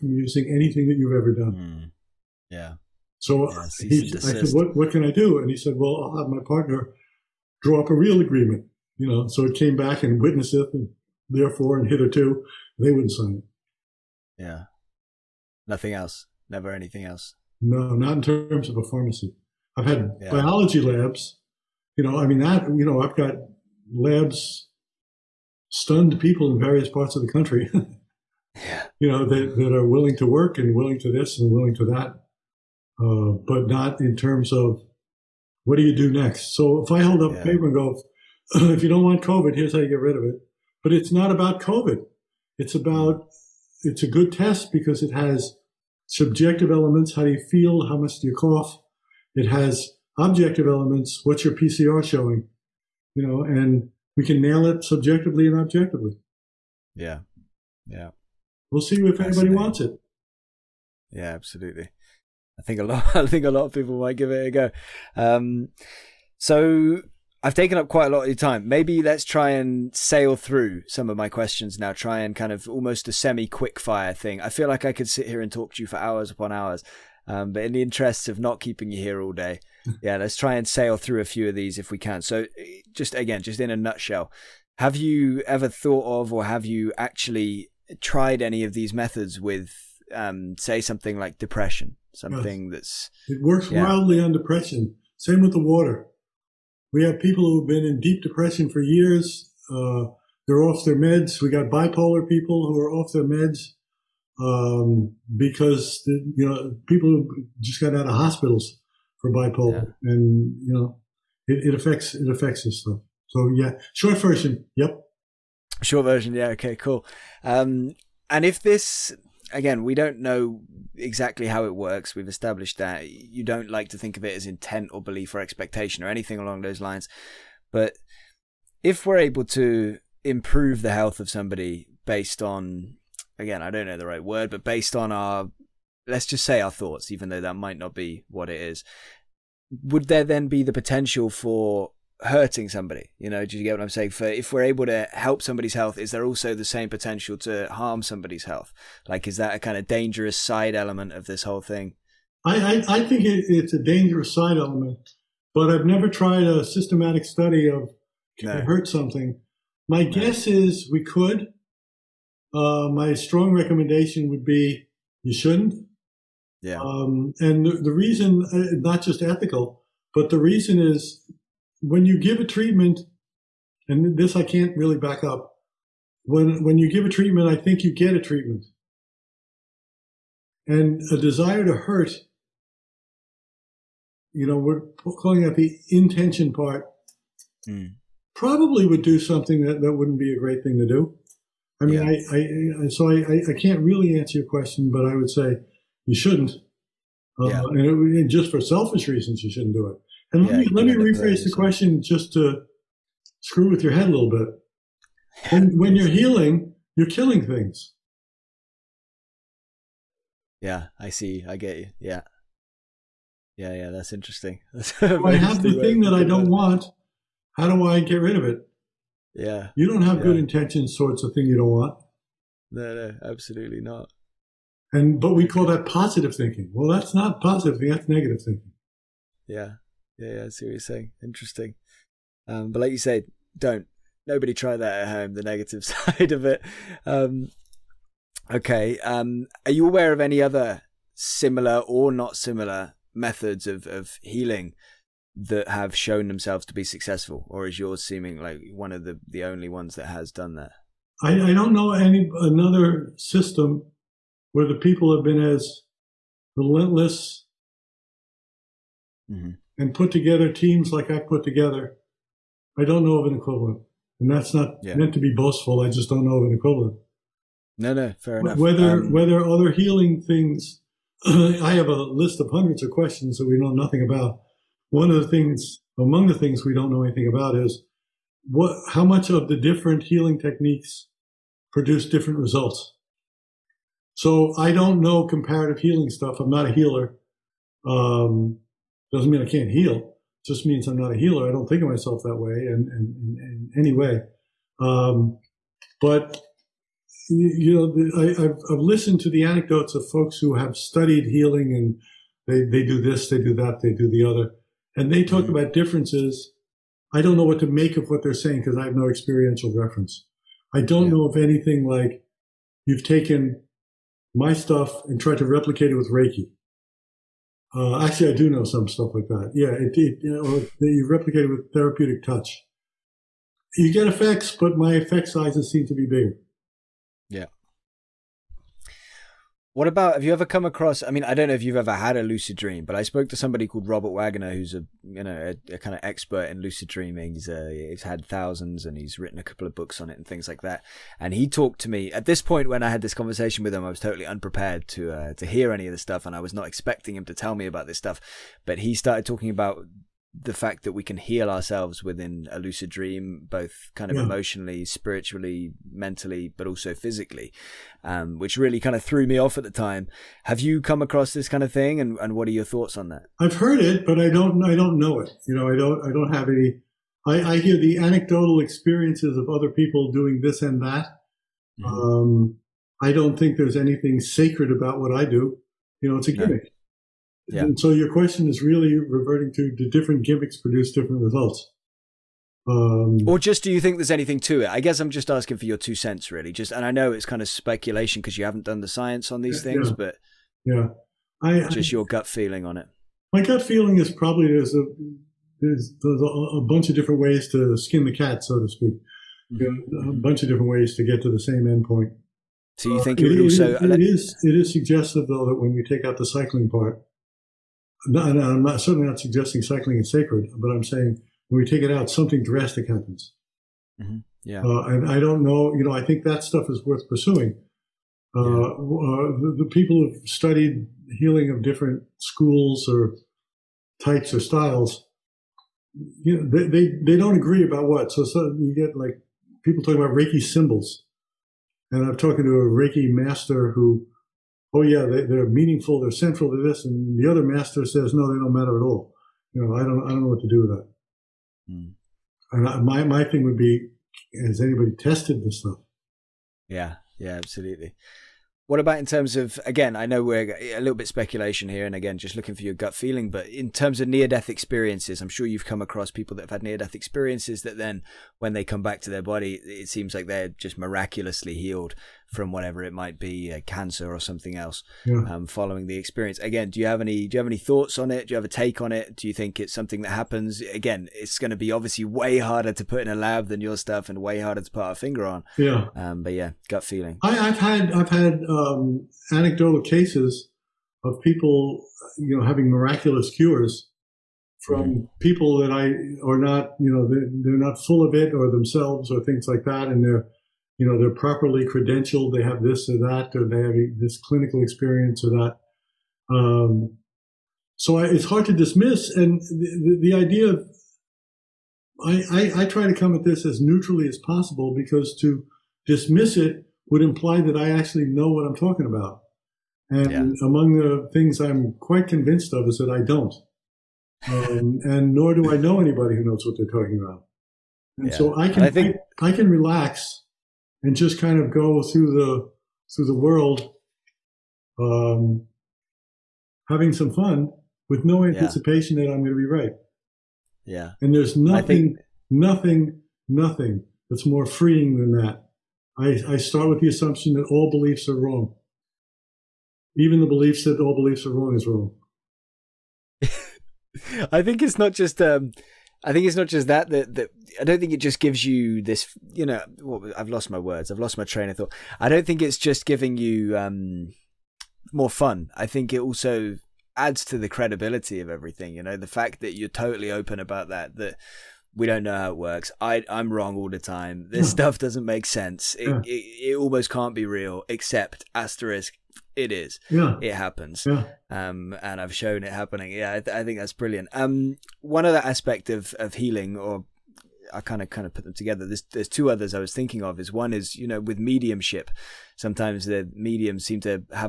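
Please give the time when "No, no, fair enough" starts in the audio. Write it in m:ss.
4:27.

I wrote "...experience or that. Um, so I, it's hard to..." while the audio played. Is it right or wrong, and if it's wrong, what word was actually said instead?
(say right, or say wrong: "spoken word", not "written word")
right.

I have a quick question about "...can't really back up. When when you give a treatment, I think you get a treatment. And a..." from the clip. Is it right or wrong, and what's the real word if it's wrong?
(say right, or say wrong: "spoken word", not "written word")
right.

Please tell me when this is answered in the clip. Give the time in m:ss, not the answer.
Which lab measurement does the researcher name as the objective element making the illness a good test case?
0:51.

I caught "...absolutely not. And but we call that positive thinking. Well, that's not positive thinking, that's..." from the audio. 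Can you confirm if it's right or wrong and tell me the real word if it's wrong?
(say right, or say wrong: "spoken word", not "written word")
right.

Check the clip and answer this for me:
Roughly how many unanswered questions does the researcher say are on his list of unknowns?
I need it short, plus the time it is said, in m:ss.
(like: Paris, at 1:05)
hundreds, at 4:32.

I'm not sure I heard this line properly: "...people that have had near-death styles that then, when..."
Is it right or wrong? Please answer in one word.
wrong.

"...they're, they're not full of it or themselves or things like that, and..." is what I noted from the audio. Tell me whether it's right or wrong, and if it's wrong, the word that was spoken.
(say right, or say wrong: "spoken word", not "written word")
right.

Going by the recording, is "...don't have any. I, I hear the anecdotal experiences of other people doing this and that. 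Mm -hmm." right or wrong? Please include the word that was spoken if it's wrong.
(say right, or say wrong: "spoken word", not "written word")
right.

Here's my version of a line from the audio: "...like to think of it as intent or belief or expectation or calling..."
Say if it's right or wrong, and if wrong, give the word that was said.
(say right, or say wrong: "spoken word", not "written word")
wrong: "anything", not "calling".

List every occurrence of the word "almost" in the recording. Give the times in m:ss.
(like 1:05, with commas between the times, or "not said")
1:12, 9:26.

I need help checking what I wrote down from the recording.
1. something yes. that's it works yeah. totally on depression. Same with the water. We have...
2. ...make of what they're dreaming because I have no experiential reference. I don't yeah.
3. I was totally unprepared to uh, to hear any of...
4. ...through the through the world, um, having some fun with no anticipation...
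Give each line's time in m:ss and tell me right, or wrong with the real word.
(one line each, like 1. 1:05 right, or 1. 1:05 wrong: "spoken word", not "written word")
1. 1:32 wrong: "wildly", not "totally"
2. 5:07 wrong: "saying", not "dreaming"
3. 5:43 right
4. 8:41 right.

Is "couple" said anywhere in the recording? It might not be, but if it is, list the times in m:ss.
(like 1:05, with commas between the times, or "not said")
5:39.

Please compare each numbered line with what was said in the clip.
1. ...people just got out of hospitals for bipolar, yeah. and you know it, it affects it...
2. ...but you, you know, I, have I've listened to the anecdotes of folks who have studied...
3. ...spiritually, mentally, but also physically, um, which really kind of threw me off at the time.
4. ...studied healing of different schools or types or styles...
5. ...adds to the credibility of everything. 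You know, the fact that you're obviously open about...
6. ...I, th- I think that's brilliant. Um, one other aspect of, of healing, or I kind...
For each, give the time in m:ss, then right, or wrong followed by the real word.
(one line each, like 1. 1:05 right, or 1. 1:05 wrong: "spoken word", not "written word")
1. 1:46 right
2. 4:56 right
3. 5:54 right
4. 7:00 right
5. 9:16 wrong: "totally", not "obviously"
6. 9:33 right.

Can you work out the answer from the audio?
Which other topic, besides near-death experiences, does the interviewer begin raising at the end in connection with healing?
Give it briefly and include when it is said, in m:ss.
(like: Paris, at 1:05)
mediumship, at 9:41.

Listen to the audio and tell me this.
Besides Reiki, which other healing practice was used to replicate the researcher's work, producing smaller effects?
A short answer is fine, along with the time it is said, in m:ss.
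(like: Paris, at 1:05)
therapeutic touch, at 5:21.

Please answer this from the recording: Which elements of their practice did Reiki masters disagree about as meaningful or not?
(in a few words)
Reiki symbols.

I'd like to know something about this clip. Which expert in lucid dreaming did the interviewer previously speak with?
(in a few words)
Robert Waggoner.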